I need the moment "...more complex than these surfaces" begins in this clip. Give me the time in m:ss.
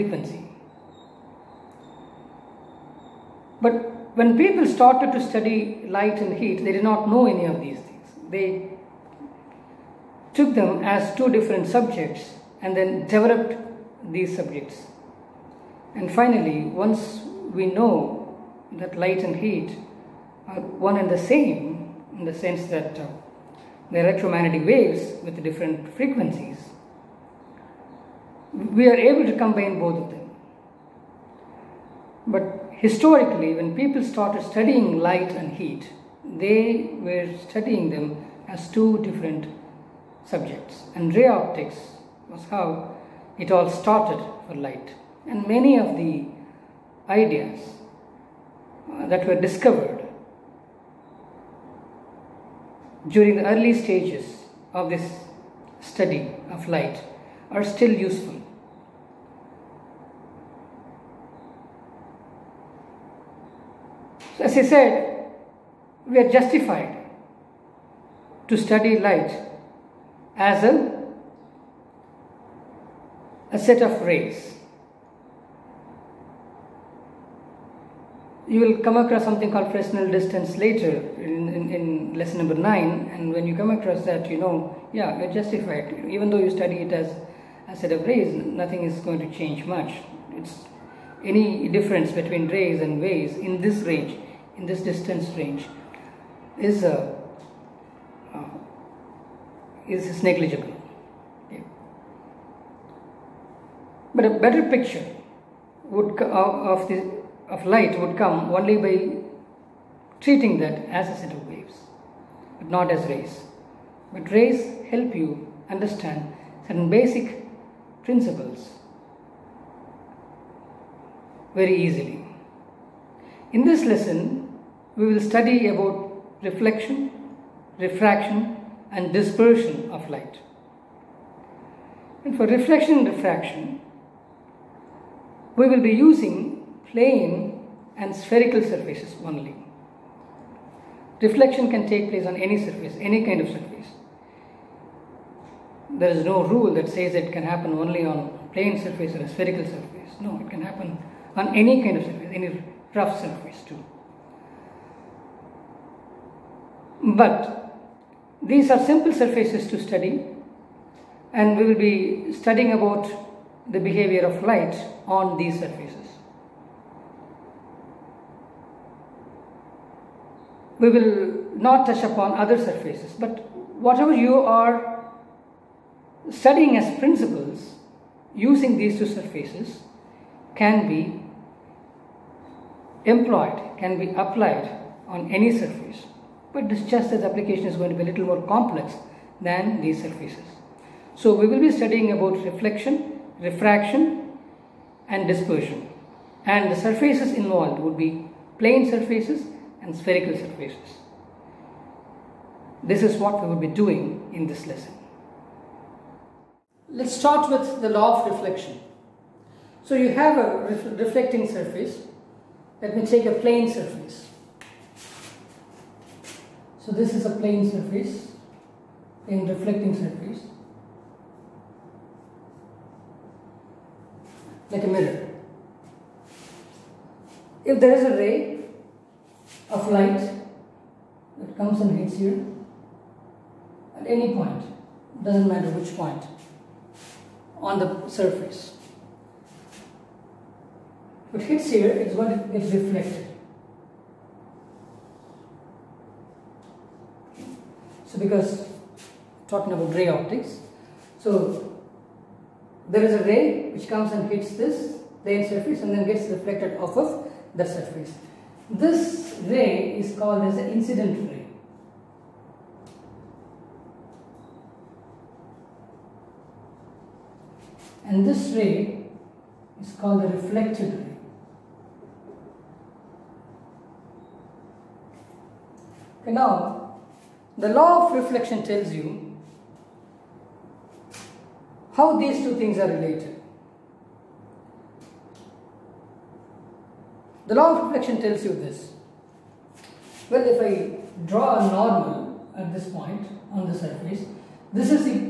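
3:08.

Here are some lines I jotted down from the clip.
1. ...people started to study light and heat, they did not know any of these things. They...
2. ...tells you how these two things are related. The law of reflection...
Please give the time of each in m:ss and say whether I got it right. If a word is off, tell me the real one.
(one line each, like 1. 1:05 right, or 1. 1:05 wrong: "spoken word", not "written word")
1. 0:04 right
2. 4:38 right.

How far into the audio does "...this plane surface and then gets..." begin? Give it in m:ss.
4:14.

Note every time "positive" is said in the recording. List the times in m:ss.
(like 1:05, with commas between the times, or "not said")
not said.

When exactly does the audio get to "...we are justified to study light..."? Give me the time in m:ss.
1:06.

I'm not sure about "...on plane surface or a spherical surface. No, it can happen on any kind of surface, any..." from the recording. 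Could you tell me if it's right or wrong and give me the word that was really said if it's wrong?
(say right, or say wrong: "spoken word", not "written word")
right.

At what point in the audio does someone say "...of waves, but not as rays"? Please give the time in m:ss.
1:51.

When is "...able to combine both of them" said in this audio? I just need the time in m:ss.
0:28.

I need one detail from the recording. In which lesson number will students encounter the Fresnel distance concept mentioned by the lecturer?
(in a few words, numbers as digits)
9.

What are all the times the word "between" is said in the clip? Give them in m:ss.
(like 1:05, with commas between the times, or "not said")
1:32.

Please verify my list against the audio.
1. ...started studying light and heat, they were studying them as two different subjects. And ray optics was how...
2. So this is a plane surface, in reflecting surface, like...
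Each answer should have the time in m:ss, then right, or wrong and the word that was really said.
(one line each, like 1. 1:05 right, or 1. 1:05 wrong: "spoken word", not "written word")
1. 0:34 right
2. 3:36 right.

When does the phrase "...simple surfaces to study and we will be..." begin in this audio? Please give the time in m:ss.
2:38.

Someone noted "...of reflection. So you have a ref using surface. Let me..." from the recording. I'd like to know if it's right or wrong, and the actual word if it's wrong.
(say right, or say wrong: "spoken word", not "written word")
wrong: "reflecting", not "using".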